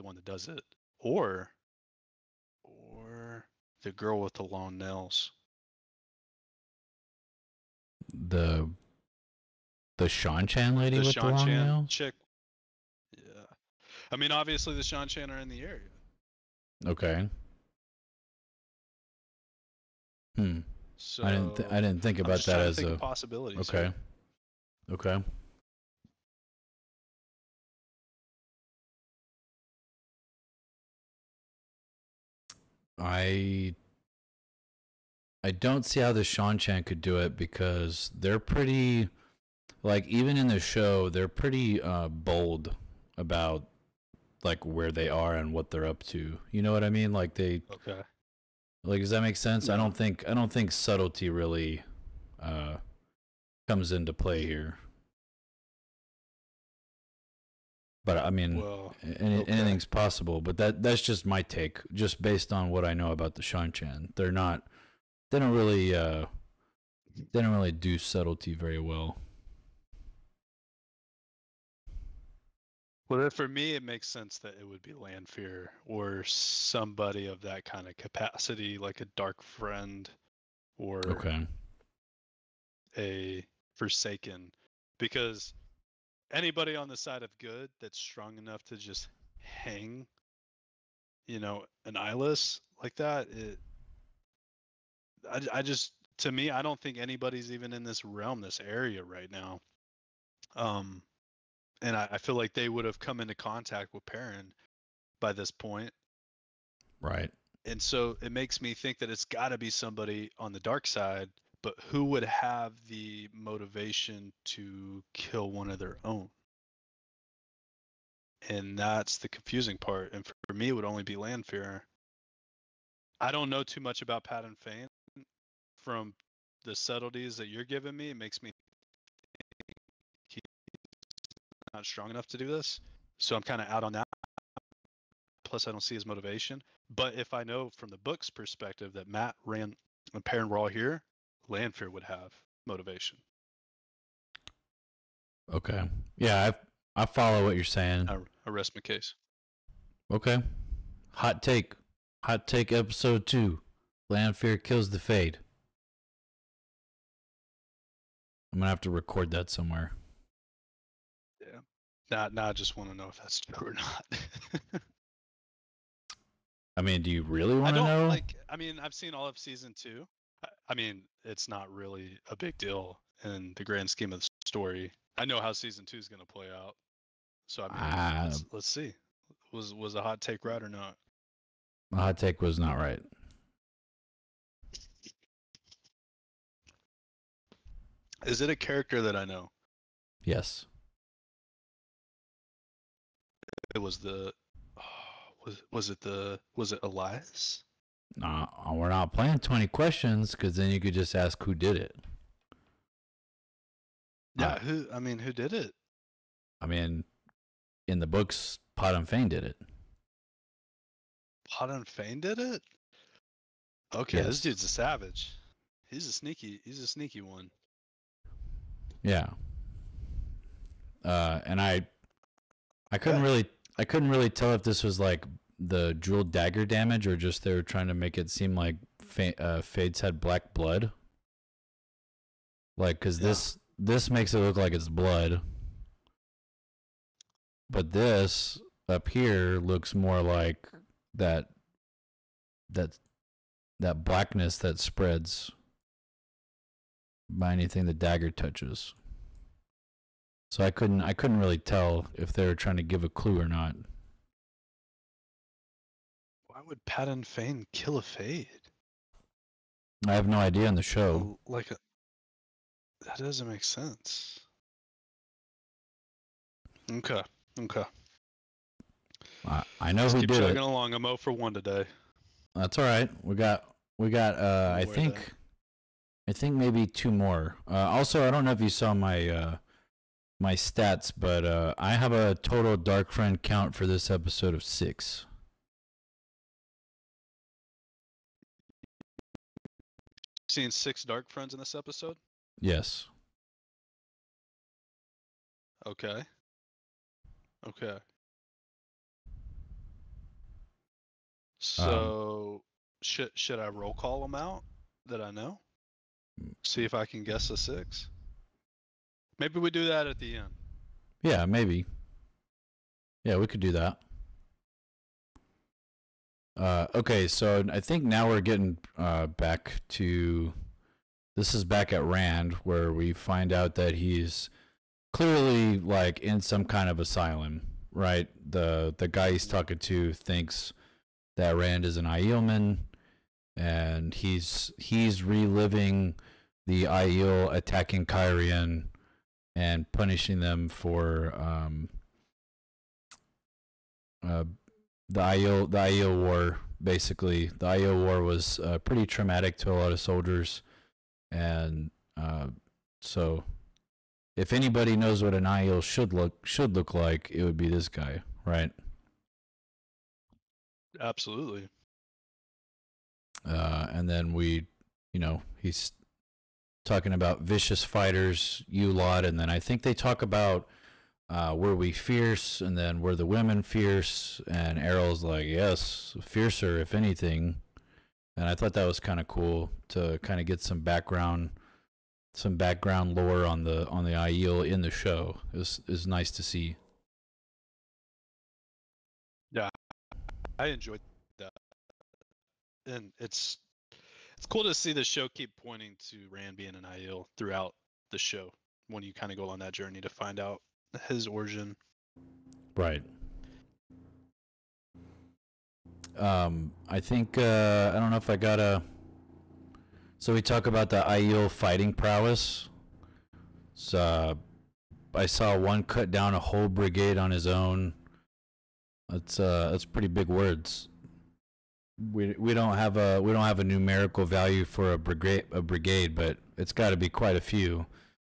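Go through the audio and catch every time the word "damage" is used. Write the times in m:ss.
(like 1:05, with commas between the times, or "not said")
3:46.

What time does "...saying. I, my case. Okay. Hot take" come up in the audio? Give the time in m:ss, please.
2:27.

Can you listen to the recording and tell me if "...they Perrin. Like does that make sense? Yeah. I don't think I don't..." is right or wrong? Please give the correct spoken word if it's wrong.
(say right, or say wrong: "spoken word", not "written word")
wrong: "Okay", not "Perrin".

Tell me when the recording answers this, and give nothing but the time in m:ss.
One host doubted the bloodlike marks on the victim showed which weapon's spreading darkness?
3:45.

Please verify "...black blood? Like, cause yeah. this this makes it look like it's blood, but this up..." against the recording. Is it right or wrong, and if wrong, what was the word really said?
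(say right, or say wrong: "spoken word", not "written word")
right.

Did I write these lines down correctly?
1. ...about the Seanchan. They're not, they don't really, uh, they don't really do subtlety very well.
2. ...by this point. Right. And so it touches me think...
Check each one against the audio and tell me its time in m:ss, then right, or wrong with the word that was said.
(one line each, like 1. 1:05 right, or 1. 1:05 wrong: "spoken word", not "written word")
1. 1:03 right
2. 1:45 wrong: "makes", not "touches".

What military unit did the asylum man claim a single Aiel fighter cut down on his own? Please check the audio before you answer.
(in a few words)
A brigade.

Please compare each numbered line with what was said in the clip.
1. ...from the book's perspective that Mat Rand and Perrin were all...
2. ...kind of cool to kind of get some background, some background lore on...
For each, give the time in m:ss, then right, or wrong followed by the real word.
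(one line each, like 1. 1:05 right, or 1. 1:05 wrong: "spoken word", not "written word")
1. 2:17 right
2. 6:18 right.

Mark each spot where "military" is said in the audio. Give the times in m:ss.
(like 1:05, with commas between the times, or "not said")
not said.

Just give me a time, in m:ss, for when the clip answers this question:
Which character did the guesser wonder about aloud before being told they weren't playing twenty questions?
3:16.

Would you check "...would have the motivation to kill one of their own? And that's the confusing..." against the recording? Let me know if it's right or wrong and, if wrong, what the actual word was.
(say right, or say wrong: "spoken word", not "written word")
right.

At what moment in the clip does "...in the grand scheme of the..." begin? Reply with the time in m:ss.
2:53.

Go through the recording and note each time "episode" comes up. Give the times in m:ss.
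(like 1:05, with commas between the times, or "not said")
2:32, 4:44, 4:51.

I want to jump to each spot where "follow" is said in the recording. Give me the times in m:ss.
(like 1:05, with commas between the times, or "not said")
2:27.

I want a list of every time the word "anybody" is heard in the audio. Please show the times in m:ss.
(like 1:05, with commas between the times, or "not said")
1:26, 1:36, 5:54.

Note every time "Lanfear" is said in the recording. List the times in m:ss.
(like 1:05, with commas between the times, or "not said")
1:14, 2:01, 2:21, 2:34.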